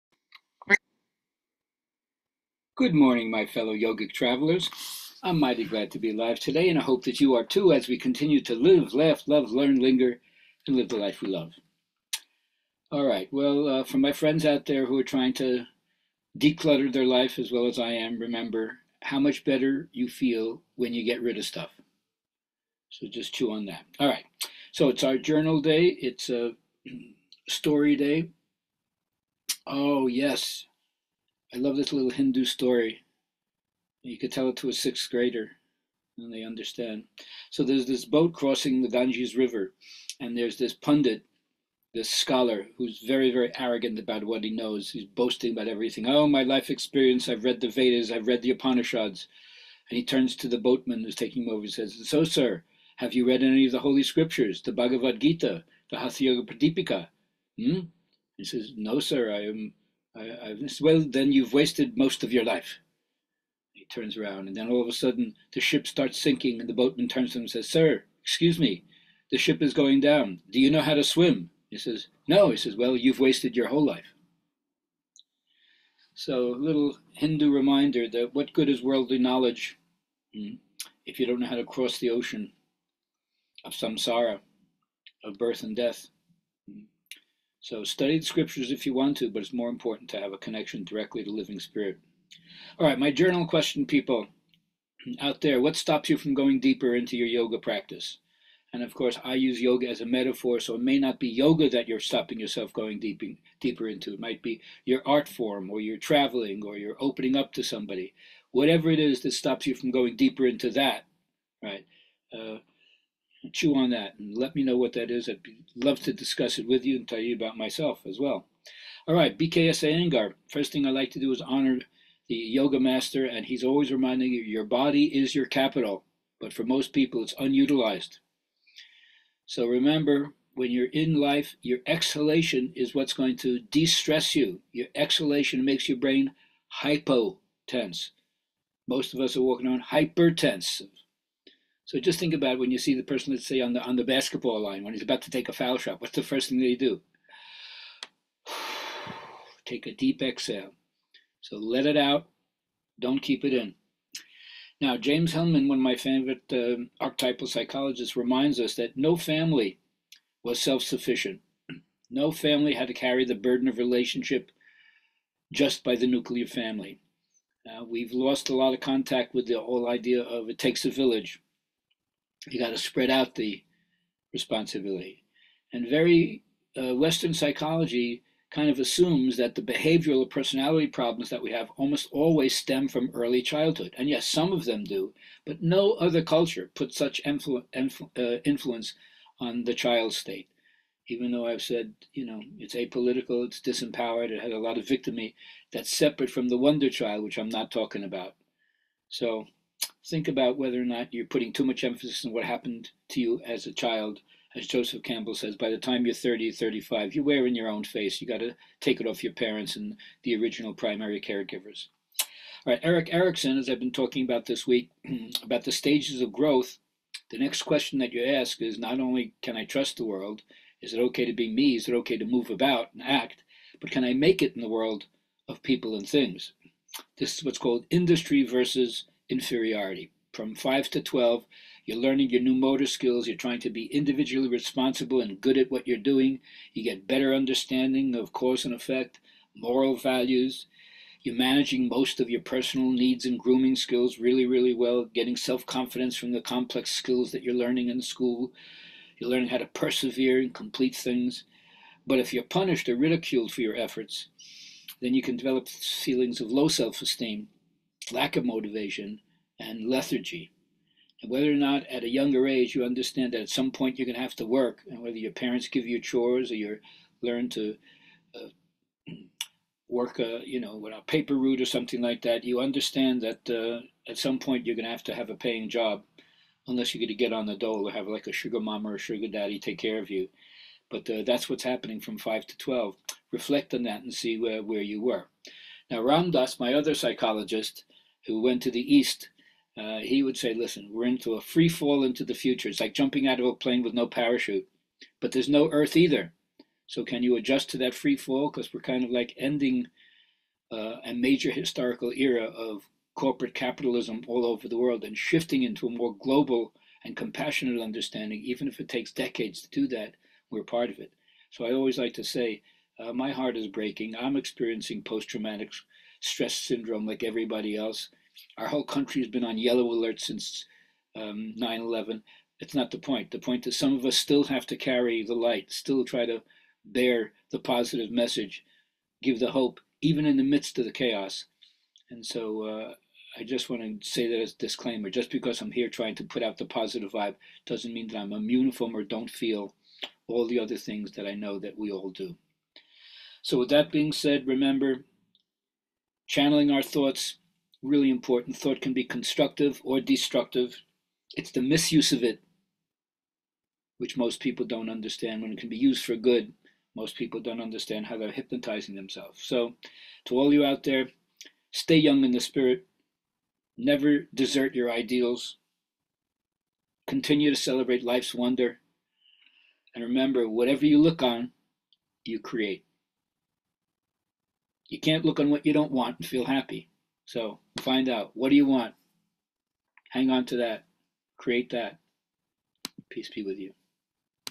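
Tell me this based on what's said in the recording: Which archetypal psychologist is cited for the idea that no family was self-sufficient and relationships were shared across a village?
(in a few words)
James Hellman.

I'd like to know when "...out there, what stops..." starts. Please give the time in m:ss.
1:35.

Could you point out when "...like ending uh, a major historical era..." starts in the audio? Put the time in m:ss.
4:59.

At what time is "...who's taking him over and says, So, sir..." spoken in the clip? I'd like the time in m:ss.
0:51.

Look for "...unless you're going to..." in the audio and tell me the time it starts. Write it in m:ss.
4:36.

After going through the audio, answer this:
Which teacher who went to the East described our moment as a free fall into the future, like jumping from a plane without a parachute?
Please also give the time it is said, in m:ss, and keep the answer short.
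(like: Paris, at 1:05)
Ramdas, at 4:45.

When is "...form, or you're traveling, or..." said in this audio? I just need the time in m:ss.
1:45.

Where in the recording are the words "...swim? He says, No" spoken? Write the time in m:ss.
1:11.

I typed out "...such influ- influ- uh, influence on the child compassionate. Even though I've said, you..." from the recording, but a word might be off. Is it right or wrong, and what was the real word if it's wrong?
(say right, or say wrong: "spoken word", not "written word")
wrong: "state", not "compassionate".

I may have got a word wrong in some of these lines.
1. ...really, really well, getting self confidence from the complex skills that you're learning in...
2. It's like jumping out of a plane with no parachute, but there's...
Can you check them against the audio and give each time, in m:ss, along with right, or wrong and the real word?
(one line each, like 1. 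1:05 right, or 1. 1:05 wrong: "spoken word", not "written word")
1. 4:04 right
2. 4:52 right.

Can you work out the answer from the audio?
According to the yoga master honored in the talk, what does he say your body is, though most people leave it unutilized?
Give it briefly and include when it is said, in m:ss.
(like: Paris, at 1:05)
your capital, at 2:05.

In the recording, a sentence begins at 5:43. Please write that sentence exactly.
So, with that being said, remember channeling our thoughts, really important.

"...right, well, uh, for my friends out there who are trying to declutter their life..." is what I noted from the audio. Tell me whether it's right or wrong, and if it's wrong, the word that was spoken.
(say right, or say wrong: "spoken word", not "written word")
right.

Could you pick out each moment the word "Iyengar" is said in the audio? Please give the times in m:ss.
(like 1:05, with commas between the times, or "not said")
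1:59.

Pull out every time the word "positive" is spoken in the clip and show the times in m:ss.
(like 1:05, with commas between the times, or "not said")
5:27, 5:36.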